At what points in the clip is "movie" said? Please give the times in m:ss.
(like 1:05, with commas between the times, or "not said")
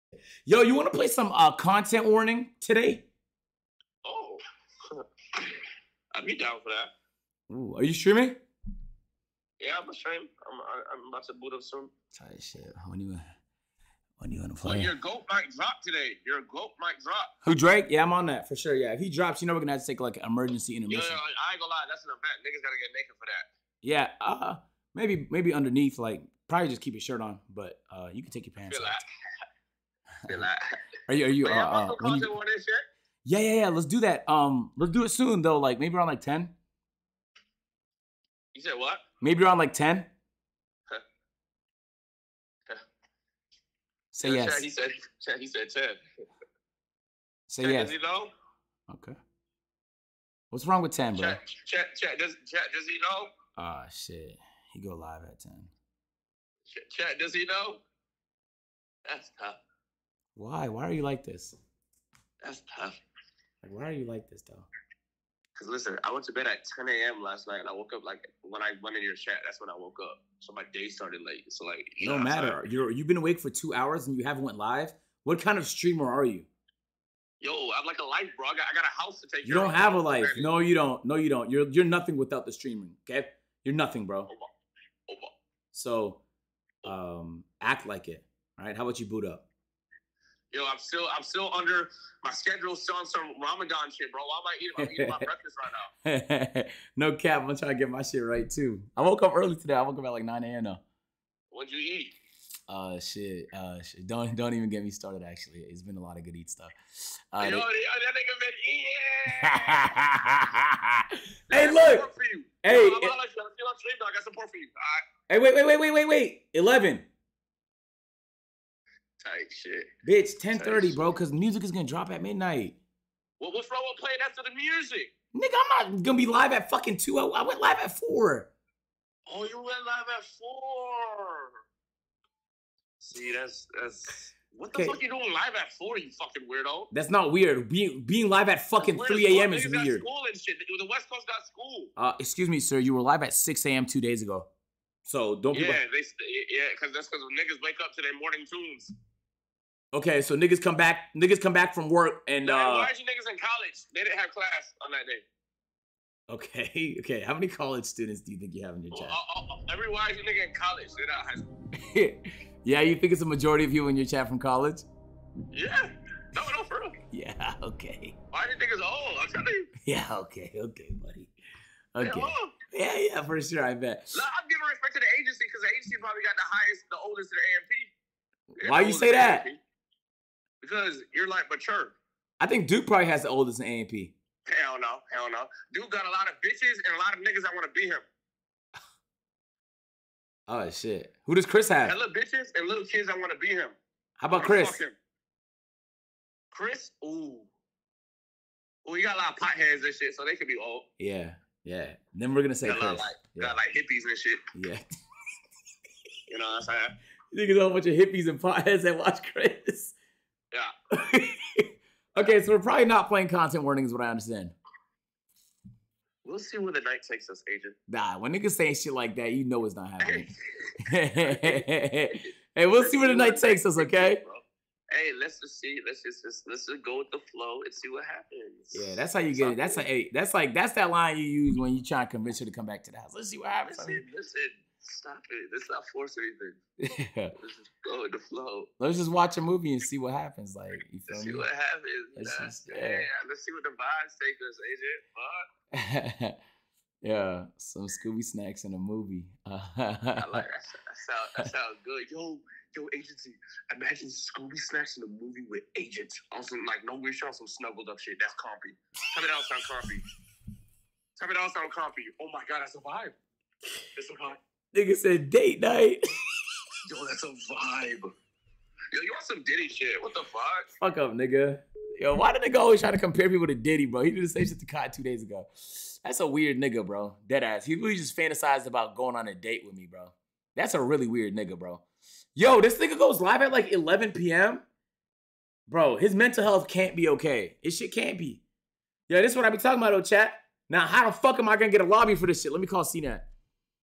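3:59, 4:08, 4:15.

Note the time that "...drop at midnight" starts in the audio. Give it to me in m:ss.
2:01.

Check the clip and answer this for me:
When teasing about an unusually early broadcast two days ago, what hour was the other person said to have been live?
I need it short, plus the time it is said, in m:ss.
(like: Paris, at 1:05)
6 a.m., at 2:23.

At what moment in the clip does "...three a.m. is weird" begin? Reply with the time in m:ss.
2:19.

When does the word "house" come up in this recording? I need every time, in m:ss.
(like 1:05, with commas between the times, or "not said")
1:19, 3:52.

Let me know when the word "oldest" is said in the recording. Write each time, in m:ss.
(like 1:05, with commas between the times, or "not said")
2:57, 3:03.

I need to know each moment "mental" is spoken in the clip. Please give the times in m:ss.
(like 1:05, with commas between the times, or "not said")
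4:46.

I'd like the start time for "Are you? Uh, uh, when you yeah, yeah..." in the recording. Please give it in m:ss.
0:31.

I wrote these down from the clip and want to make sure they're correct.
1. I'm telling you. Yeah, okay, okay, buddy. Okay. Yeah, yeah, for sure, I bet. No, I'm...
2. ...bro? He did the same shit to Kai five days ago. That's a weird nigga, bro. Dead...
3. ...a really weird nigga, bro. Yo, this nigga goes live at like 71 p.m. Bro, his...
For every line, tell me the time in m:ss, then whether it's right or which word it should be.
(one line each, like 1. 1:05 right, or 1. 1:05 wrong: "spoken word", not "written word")
1. 2:49 right
2. 4:33 wrong: "two", not "five"
3. 4:40 wrong: "11", not "71".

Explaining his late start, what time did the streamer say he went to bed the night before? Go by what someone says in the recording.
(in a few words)
10 a.m.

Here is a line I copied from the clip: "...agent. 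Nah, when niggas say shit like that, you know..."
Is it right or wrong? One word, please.
right.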